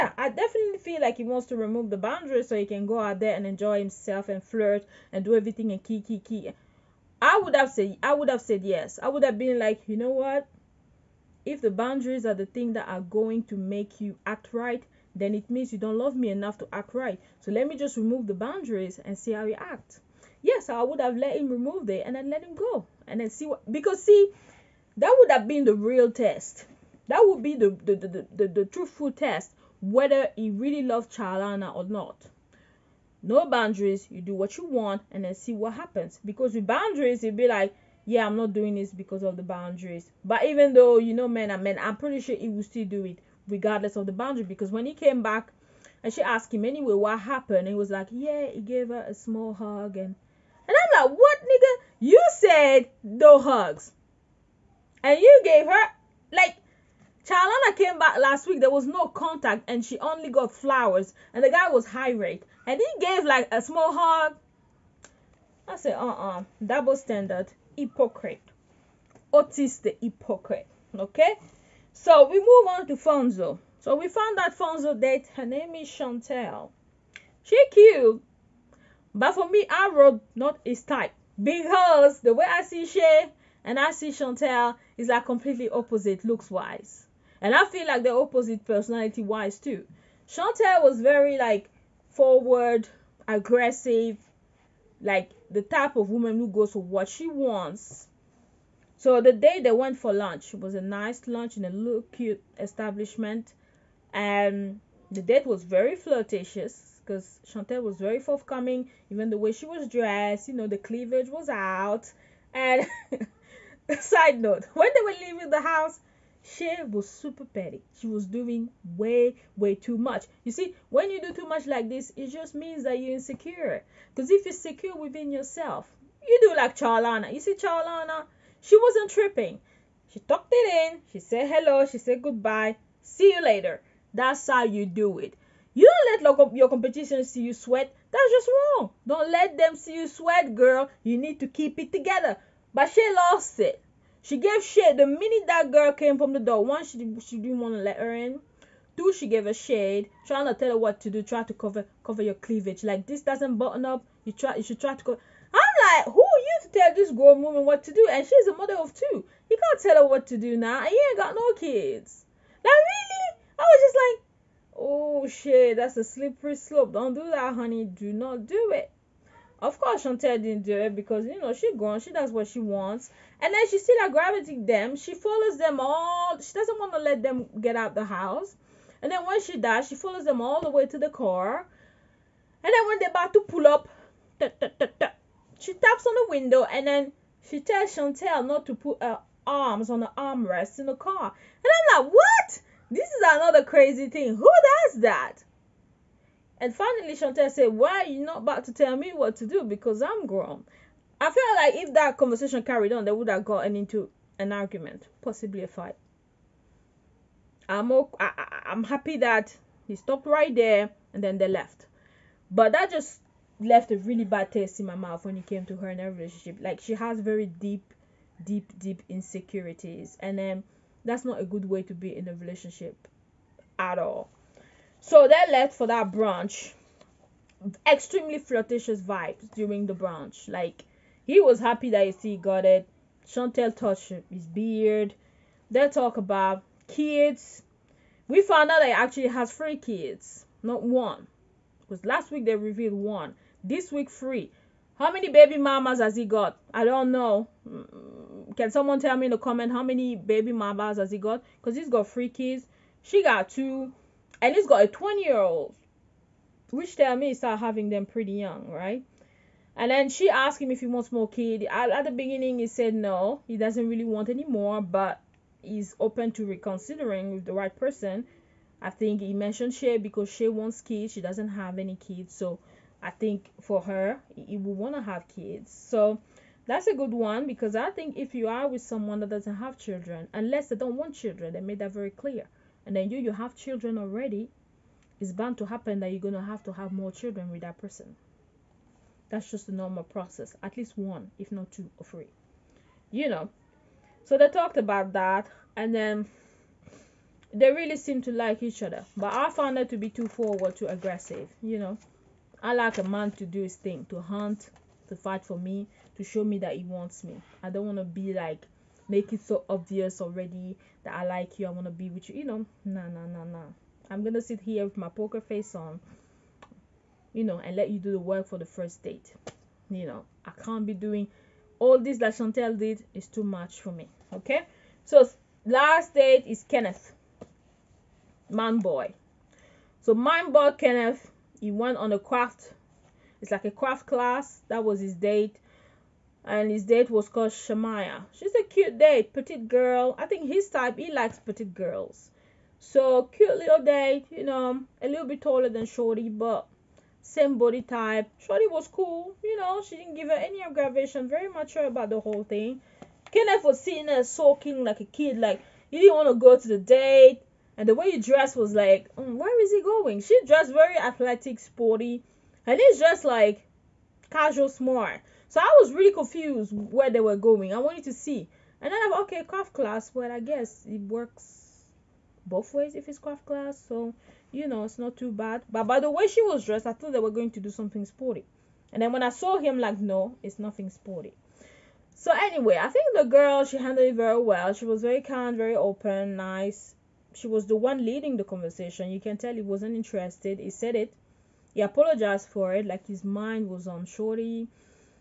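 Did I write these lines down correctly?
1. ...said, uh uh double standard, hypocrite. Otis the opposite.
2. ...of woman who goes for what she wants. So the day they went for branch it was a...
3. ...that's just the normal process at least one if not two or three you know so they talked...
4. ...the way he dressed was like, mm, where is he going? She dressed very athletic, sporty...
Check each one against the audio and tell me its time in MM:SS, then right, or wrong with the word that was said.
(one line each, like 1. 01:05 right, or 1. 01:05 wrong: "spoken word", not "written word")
1. 01:05 wrong: "hypocrite", not "opposite"
2. 01:35 wrong: "lunch", not "branch"
3. 04:49 right
4. 05:57 right.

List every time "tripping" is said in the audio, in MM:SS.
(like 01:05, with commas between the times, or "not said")
02:09.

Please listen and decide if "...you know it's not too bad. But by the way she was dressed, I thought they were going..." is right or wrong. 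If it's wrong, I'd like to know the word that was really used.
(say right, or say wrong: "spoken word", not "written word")
right.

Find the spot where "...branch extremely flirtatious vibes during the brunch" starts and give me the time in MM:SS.
03:46.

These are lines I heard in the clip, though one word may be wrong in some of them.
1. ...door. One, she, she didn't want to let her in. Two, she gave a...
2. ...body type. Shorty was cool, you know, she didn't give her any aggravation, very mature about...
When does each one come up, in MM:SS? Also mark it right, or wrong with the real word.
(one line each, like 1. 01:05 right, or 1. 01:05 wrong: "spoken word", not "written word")
1. 02:26 right
2. 05:47 right.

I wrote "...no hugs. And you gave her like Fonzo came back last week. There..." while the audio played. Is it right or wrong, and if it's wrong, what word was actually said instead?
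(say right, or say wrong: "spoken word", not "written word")
wrong: "Charlana", not "Fonzo".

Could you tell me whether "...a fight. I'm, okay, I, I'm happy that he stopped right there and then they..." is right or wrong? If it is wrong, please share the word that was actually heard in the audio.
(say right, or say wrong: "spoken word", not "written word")
right.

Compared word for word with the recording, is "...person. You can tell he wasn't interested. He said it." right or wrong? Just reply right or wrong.
wrong.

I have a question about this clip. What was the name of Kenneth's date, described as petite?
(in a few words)
Shamaya.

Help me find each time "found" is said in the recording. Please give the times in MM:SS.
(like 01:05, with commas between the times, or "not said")
01:14, 03:58, 04:59.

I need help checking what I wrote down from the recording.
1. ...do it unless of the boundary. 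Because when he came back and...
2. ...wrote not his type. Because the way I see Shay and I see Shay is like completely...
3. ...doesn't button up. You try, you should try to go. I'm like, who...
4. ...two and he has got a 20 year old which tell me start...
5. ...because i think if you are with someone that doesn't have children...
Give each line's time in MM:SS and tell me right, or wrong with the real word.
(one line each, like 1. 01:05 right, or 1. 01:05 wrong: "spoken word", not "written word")
1. 00:42 wrong: "regardless", not "unless"
2. 01:19 wrong: "Chantel", not "Shay"
3. 02:33 right
4. 04:13 right
5. 04:37 right.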